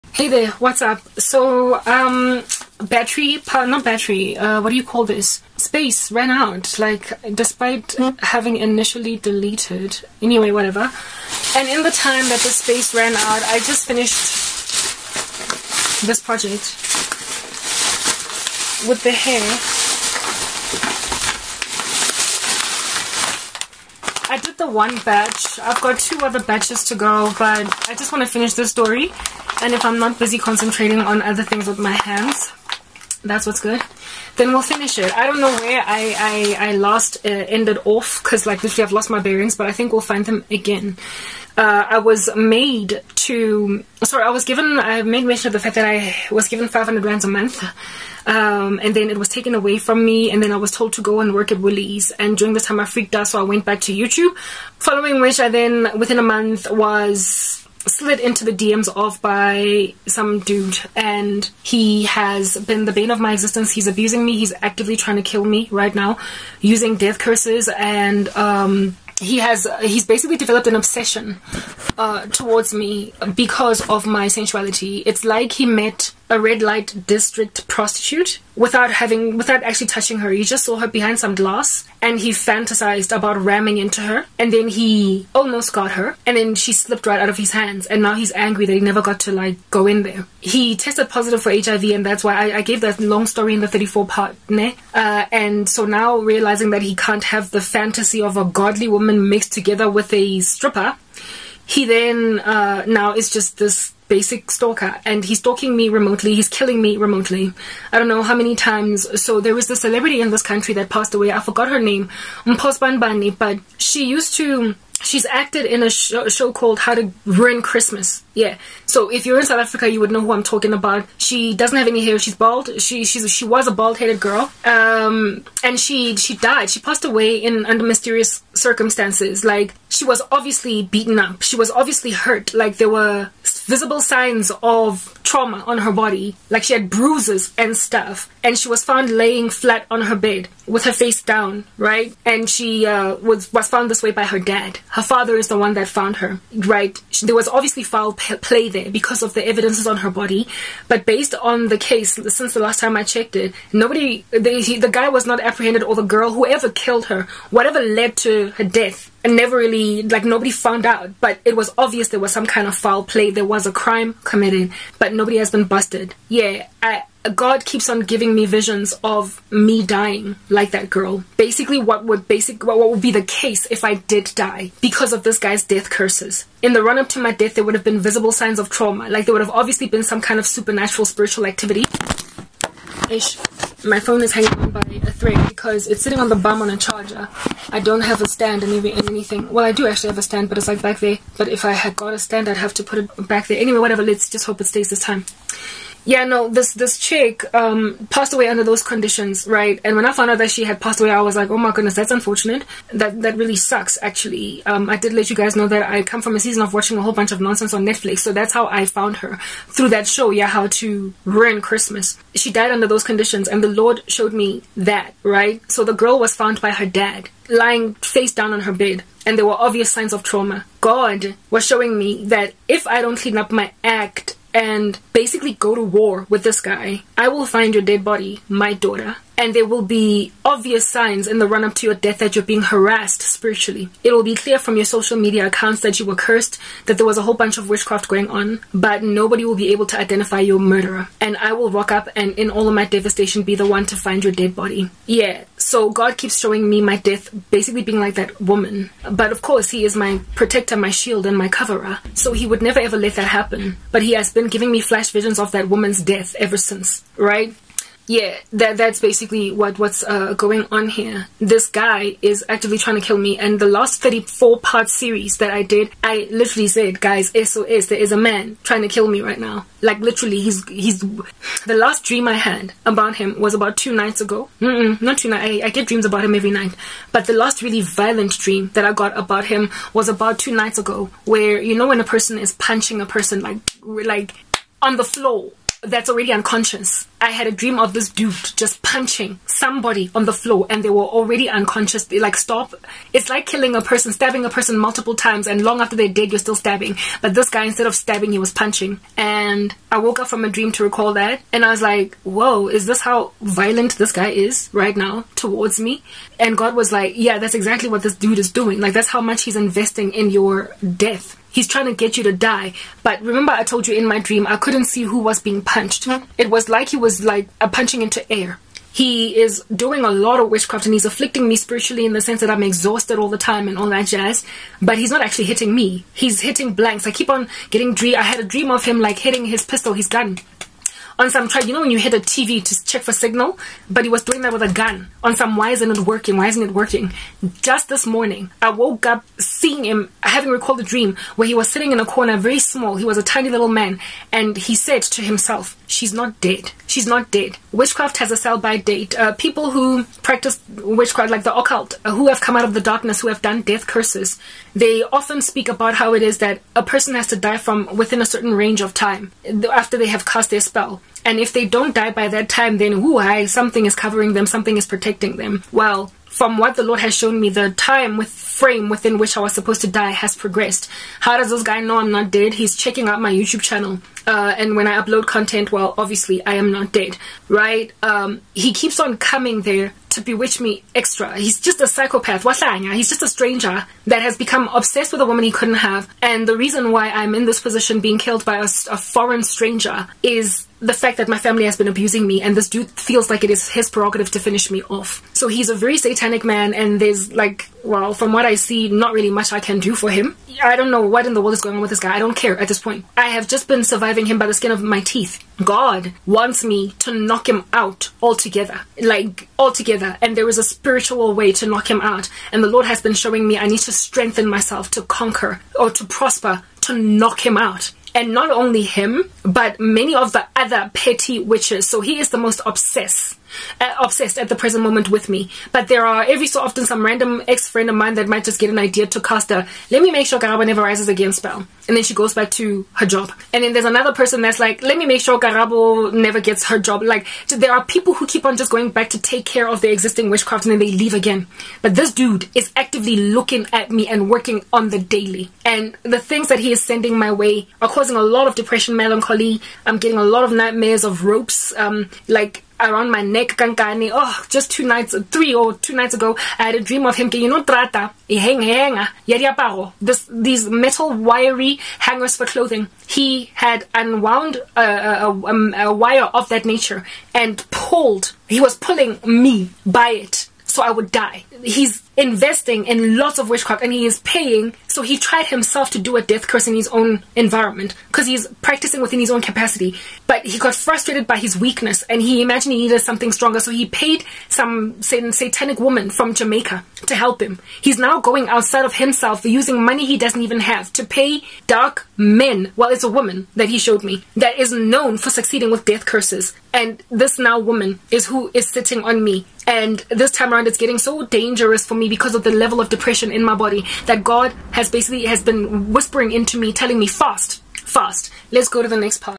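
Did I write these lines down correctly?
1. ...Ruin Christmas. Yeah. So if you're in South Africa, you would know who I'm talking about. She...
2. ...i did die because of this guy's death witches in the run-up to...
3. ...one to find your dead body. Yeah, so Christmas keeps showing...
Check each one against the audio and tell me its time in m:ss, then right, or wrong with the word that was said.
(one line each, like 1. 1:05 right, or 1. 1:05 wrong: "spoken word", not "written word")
1. 1:57 right
2. 2:53 wrong: "curses", not "witches"
3. 4:03 wrong: "God", not "Christmas".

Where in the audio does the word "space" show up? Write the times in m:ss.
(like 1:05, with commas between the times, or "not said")
0:05, 0:12.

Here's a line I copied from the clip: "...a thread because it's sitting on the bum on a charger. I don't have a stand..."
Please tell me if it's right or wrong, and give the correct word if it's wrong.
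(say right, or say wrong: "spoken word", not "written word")
right.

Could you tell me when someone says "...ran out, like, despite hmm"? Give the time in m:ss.
0:06.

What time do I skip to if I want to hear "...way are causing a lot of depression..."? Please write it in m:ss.
7:27.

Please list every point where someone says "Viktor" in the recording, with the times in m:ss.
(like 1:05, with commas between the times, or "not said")
not said.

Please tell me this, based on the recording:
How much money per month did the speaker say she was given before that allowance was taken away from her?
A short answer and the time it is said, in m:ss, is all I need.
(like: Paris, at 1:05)
500 rands, at 0:46.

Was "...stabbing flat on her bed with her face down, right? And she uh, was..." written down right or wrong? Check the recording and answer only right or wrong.
wrong.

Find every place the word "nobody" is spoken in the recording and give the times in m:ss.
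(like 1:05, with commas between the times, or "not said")
2:33, 2:40, 2:45, 3:59.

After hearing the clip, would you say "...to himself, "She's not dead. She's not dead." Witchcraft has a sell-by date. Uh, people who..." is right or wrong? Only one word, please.
right.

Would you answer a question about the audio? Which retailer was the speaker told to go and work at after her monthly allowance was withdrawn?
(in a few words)
Woolies.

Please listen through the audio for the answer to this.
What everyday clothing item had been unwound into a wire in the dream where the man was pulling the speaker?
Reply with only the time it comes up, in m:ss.
7:41.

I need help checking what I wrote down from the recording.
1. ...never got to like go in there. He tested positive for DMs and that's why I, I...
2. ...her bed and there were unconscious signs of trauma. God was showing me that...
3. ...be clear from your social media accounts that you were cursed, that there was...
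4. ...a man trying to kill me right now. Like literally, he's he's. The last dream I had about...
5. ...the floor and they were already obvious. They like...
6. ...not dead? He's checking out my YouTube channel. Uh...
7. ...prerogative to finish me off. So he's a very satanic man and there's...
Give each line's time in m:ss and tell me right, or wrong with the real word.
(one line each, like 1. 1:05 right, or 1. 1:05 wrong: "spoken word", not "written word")
1. 1:28 wrong: "HIV", not "DMs"
2. 3:38 wrong: "obvious", not "unconscious"
3. 3:54 right
4. 4:28 right
5. 4:50 wrong: "unconscious", not "obvious"
6. 6:12 right
7. 6:33 right.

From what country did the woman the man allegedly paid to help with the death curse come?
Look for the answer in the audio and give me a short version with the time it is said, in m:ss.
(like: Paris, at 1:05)
Jamaica, at 8:06.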